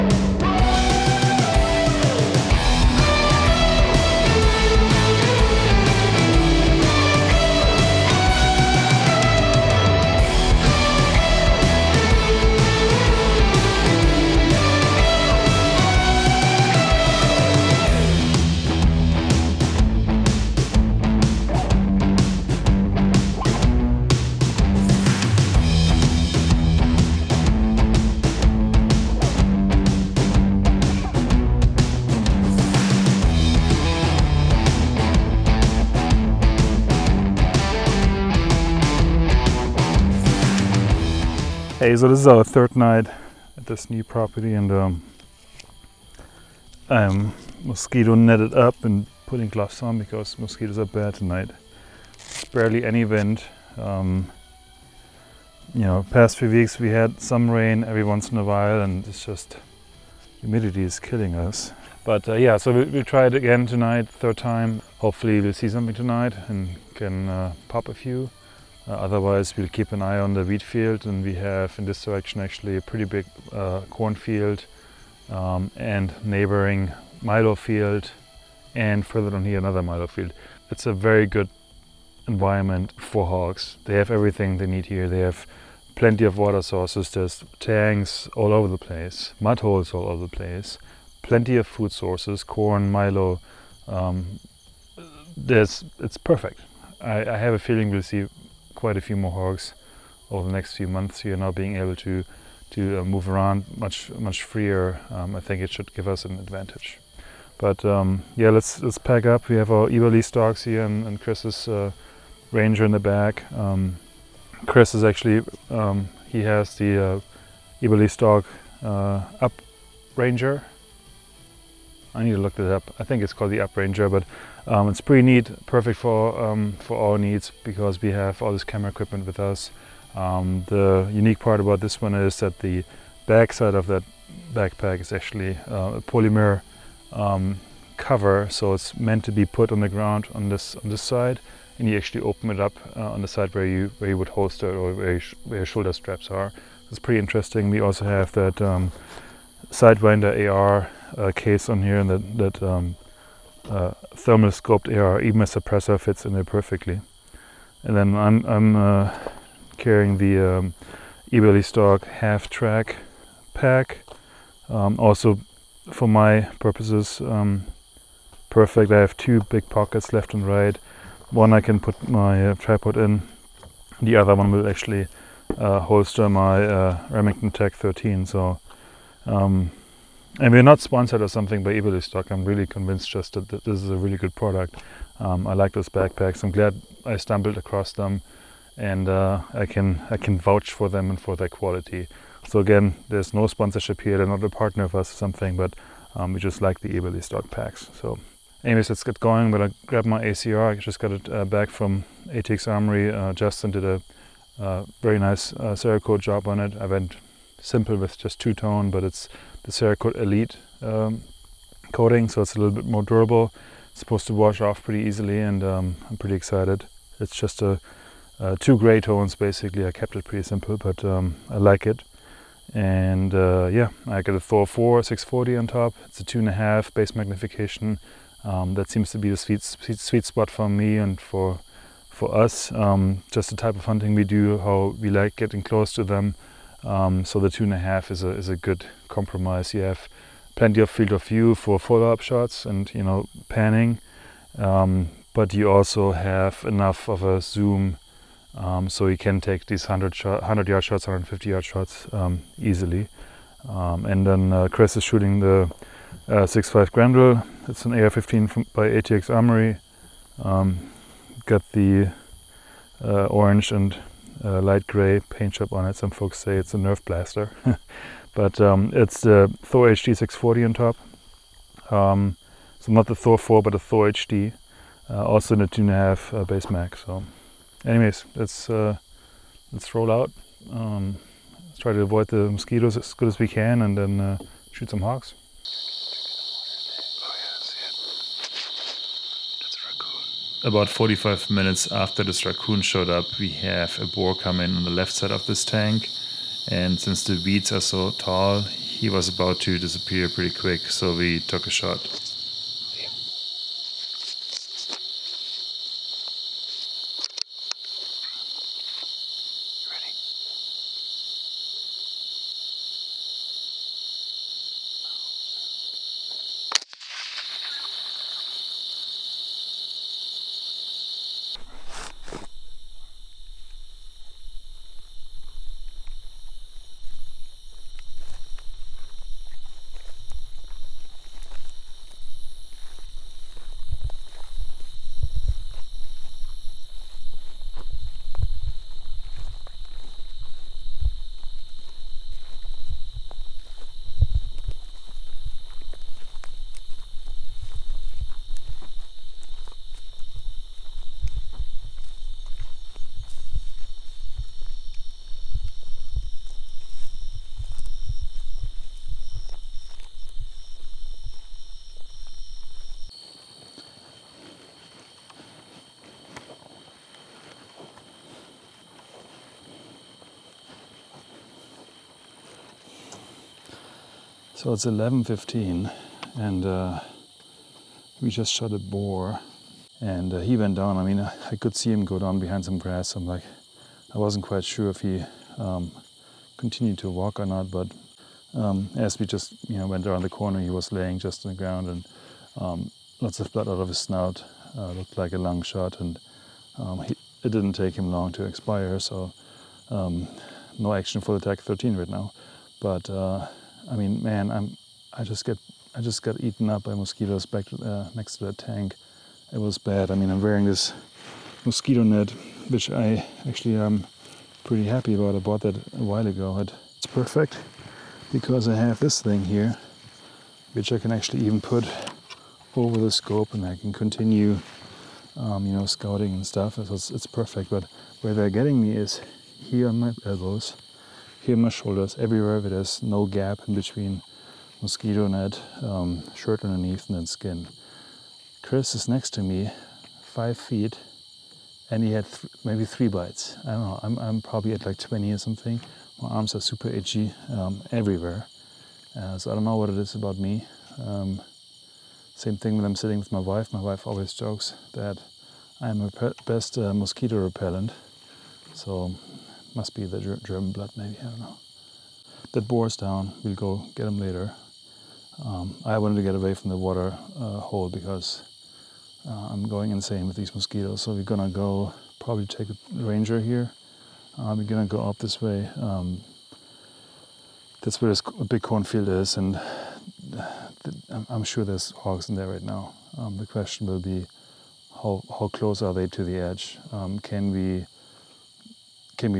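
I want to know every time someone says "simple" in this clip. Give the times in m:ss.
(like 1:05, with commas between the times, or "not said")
3:27, 3:40.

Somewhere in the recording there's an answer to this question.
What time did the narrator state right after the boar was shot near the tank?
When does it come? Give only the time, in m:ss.
6:14.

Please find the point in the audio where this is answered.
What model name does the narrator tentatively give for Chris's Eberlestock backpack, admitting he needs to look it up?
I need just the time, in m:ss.
2:03.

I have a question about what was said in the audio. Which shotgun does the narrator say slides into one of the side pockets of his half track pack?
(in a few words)
Remington TAC-13.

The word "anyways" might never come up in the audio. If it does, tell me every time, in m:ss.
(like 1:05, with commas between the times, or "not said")
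3:18, 4:37.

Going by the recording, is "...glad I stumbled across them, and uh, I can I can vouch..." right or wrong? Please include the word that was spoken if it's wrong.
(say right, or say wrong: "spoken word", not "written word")
right.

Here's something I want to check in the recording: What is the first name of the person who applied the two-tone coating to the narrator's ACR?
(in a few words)
Justin.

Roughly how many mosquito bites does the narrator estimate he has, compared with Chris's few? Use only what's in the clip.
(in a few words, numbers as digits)
20.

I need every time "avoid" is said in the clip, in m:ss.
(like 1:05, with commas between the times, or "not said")
4:42.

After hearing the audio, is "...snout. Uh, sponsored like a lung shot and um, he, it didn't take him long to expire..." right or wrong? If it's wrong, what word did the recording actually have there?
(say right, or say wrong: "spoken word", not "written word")
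wrong: "looked", not "sponsored".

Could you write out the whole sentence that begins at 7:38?
So must be the German blood, maybe, I don't know.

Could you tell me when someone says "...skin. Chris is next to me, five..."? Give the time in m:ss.
7:17.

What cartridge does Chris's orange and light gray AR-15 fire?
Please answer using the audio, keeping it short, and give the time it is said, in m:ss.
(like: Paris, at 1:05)
6.5 Grendel, at 4:16.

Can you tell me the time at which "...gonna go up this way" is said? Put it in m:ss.
7:54.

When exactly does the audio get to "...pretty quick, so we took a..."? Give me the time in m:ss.
5:00.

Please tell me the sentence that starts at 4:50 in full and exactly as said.
about 45 minutes after this raccoon showed up, we have a boar come in on the left side of this tank.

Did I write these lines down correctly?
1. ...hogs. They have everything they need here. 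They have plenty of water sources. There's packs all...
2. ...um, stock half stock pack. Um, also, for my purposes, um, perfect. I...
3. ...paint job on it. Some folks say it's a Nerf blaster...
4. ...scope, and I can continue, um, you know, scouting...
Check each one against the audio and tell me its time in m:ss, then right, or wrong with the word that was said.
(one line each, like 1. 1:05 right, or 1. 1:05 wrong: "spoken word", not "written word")
1. 1:23 wrong: "tanks", not "packs"
2. 2:41 wrong: "track", not "stock"
3. 4:25 right
4. 7:03 right.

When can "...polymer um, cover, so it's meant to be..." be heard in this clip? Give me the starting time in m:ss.
2:16.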